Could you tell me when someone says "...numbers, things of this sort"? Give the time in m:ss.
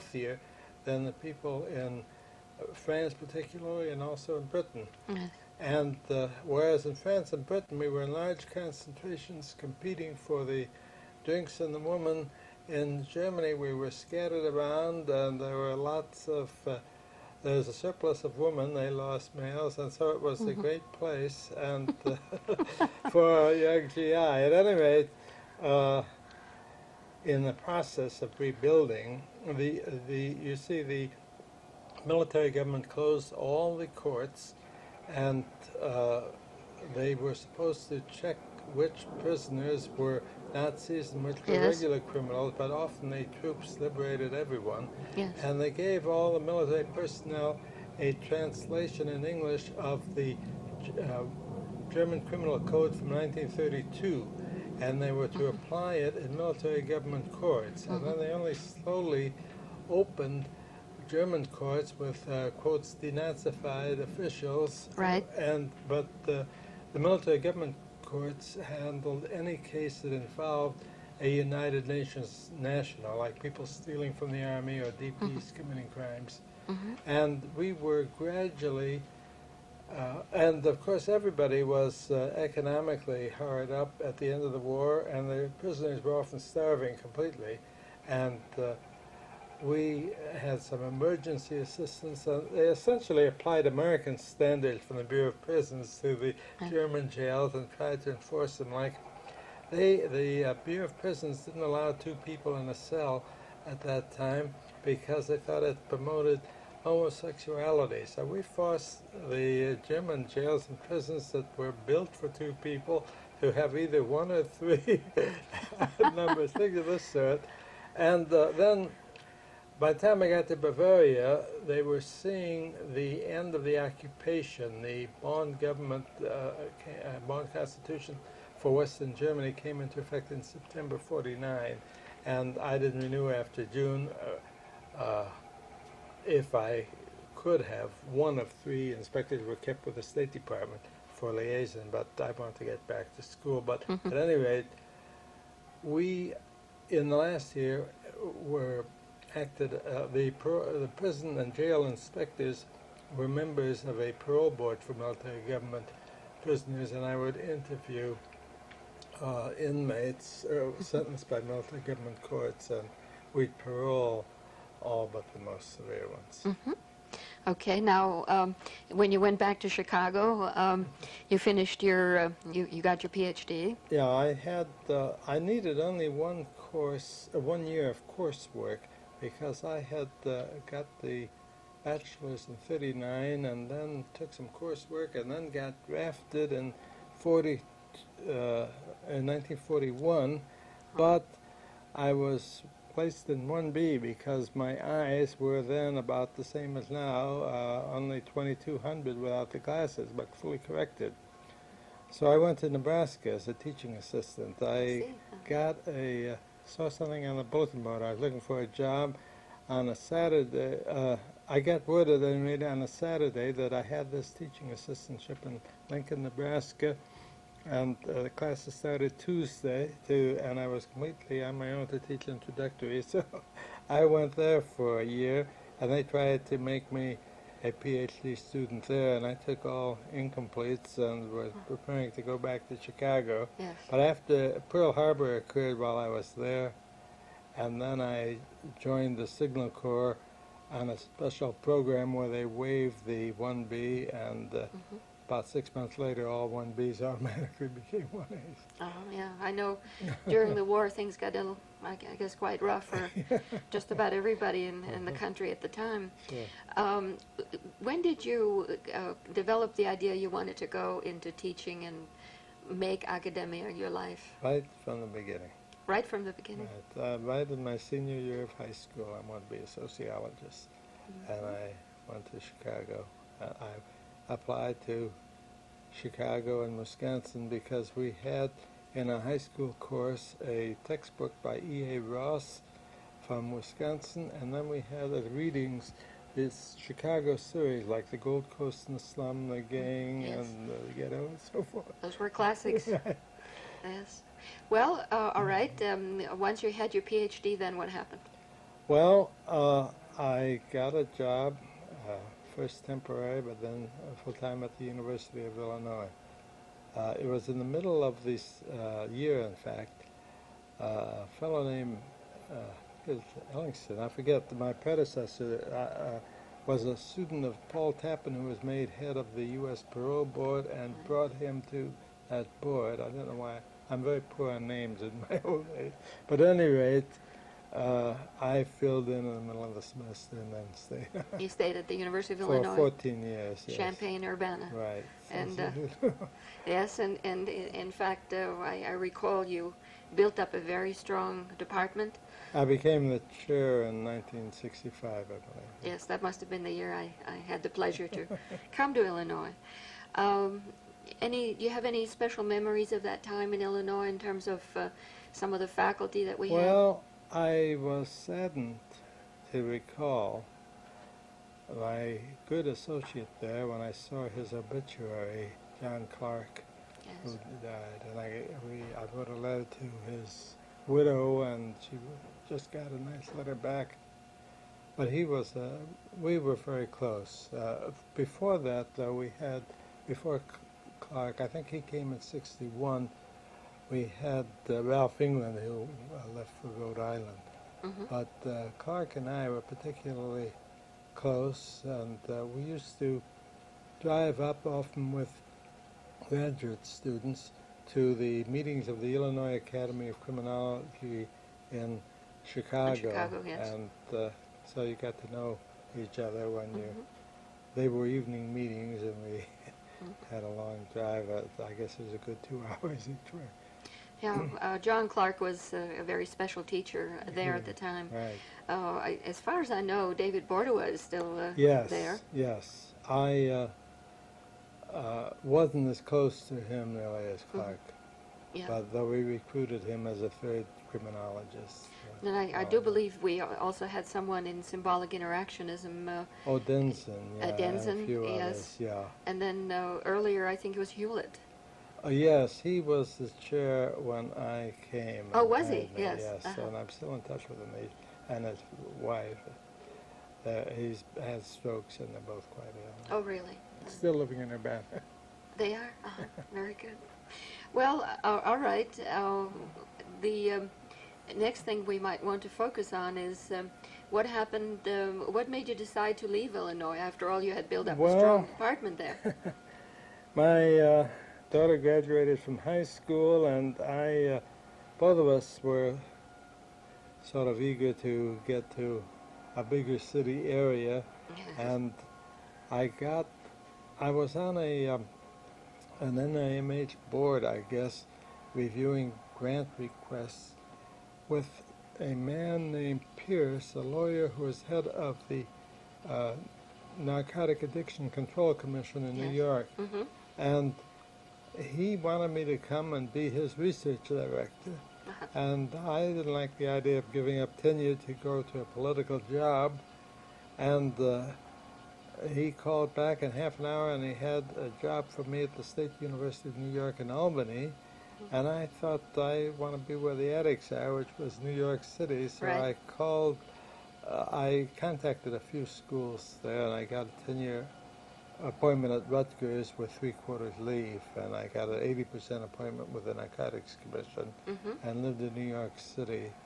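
1:56.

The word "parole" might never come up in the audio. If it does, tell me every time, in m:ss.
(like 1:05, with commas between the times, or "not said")
2:34, 2:43, 5:19.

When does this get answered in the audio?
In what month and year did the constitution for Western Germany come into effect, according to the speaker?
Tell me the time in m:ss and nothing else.
2:10.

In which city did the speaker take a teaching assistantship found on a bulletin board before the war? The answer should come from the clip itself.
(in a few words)
Lincoln, Nebraska.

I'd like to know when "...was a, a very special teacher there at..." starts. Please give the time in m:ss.
6:55.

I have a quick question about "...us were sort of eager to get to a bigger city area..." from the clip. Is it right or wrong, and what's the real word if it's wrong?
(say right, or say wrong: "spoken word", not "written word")
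right.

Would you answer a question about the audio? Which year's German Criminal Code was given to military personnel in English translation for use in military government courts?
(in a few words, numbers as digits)
1932.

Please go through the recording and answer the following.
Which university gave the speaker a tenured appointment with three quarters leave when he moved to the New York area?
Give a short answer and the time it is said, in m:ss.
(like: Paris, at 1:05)
Rutgers, at 8:49.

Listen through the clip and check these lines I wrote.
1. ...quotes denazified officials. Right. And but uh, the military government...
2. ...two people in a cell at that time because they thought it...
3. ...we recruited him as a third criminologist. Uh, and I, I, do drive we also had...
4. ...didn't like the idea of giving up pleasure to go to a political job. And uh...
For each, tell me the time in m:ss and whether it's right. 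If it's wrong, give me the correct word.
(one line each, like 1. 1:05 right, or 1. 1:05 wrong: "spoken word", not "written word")
1. 1:02 right
2. 1:41 right
3. 7:09 wrong: "believe", not "drive"
4. 8:26 wrong: "tenure", not "pleasure".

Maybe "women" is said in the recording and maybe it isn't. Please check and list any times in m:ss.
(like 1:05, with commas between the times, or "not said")
0:11, 0:18.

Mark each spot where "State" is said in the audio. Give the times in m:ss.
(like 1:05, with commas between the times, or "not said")
2:20, 8:35.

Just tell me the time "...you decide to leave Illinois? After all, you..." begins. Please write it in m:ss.
7:45.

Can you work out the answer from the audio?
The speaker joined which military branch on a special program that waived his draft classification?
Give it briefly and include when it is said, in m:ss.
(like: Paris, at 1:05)
Signal Corps, at 3:59.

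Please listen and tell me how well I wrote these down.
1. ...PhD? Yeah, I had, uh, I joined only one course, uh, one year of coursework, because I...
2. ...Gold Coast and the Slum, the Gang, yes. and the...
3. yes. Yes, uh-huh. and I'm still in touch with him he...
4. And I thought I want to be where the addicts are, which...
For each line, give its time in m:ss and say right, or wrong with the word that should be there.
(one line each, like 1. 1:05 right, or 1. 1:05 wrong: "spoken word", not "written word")
1. 2:53 wrong: "needed", not "joined"
2. 4:48 right
3. 7:25 right
4. 8:38 right.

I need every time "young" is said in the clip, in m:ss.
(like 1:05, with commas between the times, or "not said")
0:23.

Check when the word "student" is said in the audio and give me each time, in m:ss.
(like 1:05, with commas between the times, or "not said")
3:48, 5:16, 6:36.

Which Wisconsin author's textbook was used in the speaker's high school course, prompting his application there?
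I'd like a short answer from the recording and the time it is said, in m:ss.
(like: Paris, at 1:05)
E.A. Ross, at 4:41.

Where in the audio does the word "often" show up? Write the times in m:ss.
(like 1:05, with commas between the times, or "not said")
0:42, 1:26, 6:34.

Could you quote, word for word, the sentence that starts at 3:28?
I was looking for a job on a Saturday.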